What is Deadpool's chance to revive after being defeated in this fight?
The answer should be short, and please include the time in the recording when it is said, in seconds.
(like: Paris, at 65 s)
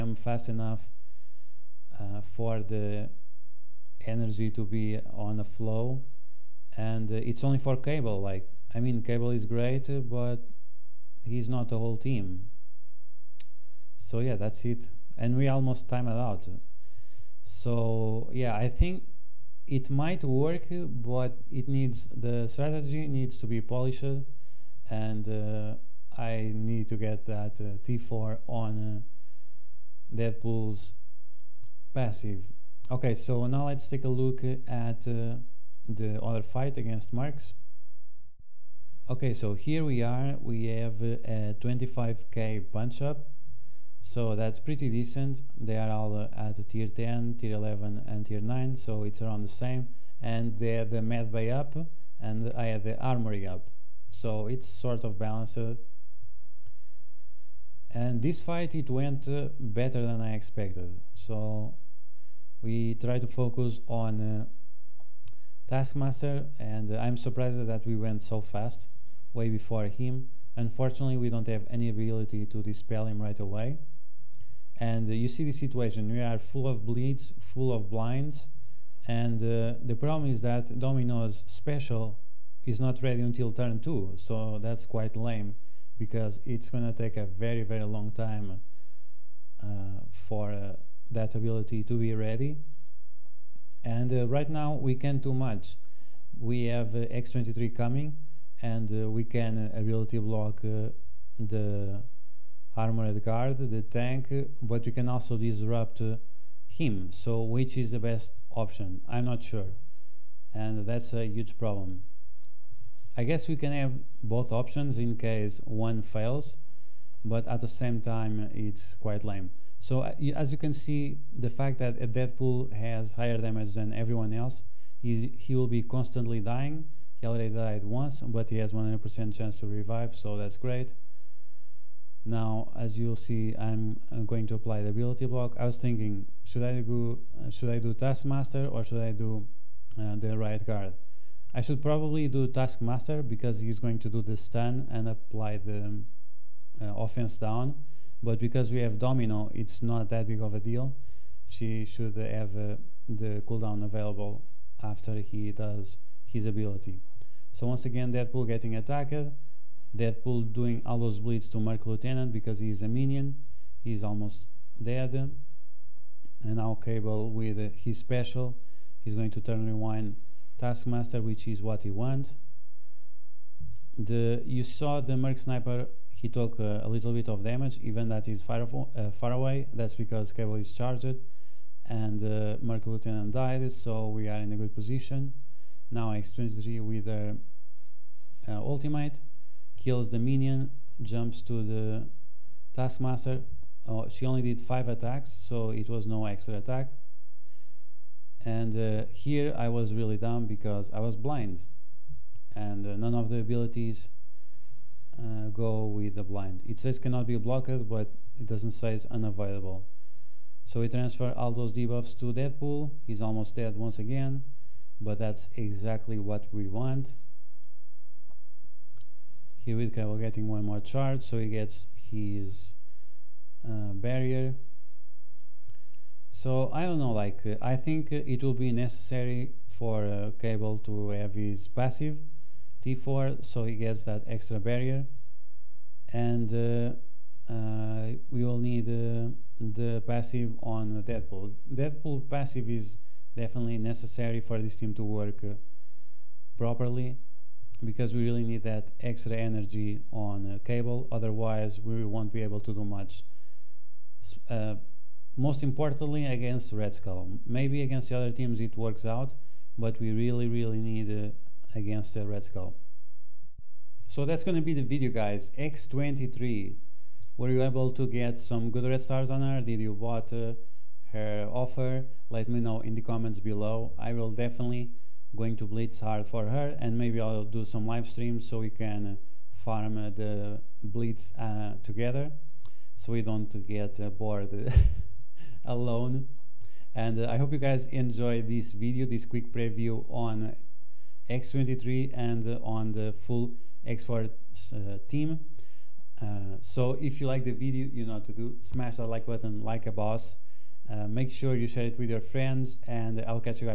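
100%, at 128 s.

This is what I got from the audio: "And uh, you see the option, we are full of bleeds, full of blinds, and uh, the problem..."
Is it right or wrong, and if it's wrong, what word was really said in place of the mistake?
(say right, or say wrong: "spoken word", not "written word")
wrong: "situation", not "option".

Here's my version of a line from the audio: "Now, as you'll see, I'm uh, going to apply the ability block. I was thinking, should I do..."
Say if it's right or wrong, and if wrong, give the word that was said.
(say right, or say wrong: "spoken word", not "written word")
right.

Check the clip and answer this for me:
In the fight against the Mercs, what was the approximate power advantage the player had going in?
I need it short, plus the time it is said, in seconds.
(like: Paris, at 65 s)
25k, at 41 s.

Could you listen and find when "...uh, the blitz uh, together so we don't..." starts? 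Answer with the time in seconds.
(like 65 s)
279 s.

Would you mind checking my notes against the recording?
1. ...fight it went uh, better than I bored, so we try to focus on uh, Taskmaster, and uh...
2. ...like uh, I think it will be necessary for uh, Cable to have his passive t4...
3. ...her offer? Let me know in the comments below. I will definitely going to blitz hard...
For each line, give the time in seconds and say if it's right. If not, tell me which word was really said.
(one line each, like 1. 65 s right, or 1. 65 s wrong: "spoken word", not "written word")
1. 58 s wrong: "expected", not "bored"
2. 227 s right
3. 271 s right.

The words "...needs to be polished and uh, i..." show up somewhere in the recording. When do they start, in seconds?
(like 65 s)
23 s.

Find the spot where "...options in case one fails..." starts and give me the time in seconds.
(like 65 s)
114 s.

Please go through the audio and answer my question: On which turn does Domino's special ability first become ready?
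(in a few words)
Turn 2.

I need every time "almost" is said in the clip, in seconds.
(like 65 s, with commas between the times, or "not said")
15 s, 164 s, 213 s.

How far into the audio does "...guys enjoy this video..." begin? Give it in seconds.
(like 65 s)
287 s.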